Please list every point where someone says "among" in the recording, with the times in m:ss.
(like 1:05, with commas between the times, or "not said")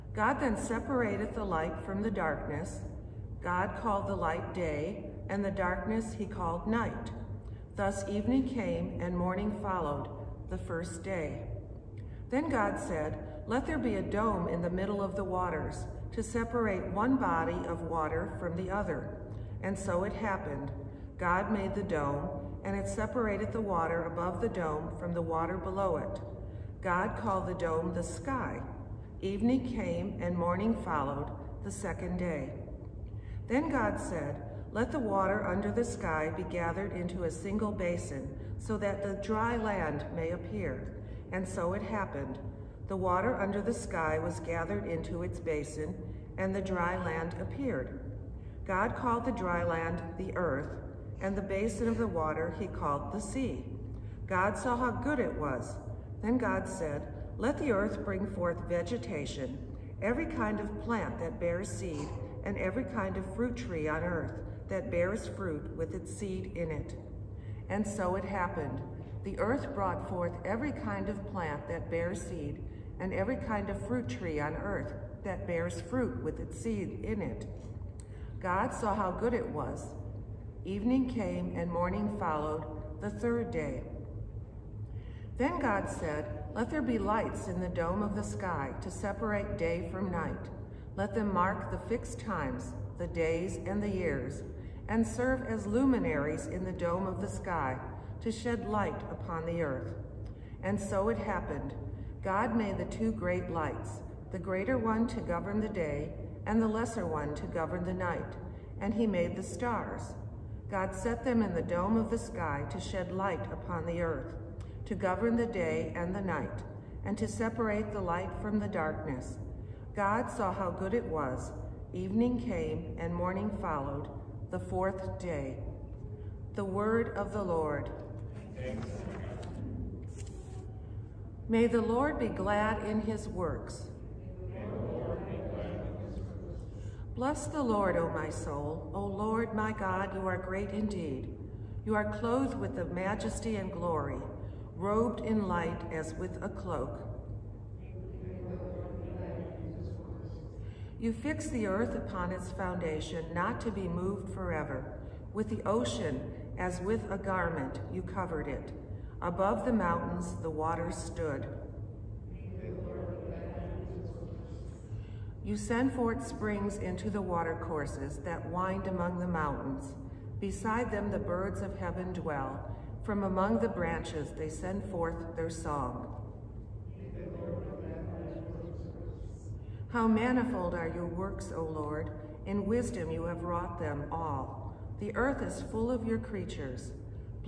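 2:48, 2:53.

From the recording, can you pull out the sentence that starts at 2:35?
With the ocean, as with a garment, you covered it.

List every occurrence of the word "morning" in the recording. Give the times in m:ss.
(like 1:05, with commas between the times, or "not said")
0:09, 0:30, 1:21, 2:03.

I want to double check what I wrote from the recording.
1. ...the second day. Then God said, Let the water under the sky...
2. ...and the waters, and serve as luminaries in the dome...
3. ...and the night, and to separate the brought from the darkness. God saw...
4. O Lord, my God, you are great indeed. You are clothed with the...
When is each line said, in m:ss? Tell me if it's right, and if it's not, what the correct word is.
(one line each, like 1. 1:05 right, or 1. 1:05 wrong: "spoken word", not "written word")
1. 0:31 right
2. 1:33 wrong: "years", not "waters"
3. 1:55 wrong: "light", not "brought"
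4. 2:18 right.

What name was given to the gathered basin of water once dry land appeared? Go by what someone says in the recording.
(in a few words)
The sea.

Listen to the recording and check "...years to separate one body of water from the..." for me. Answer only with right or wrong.
wrong.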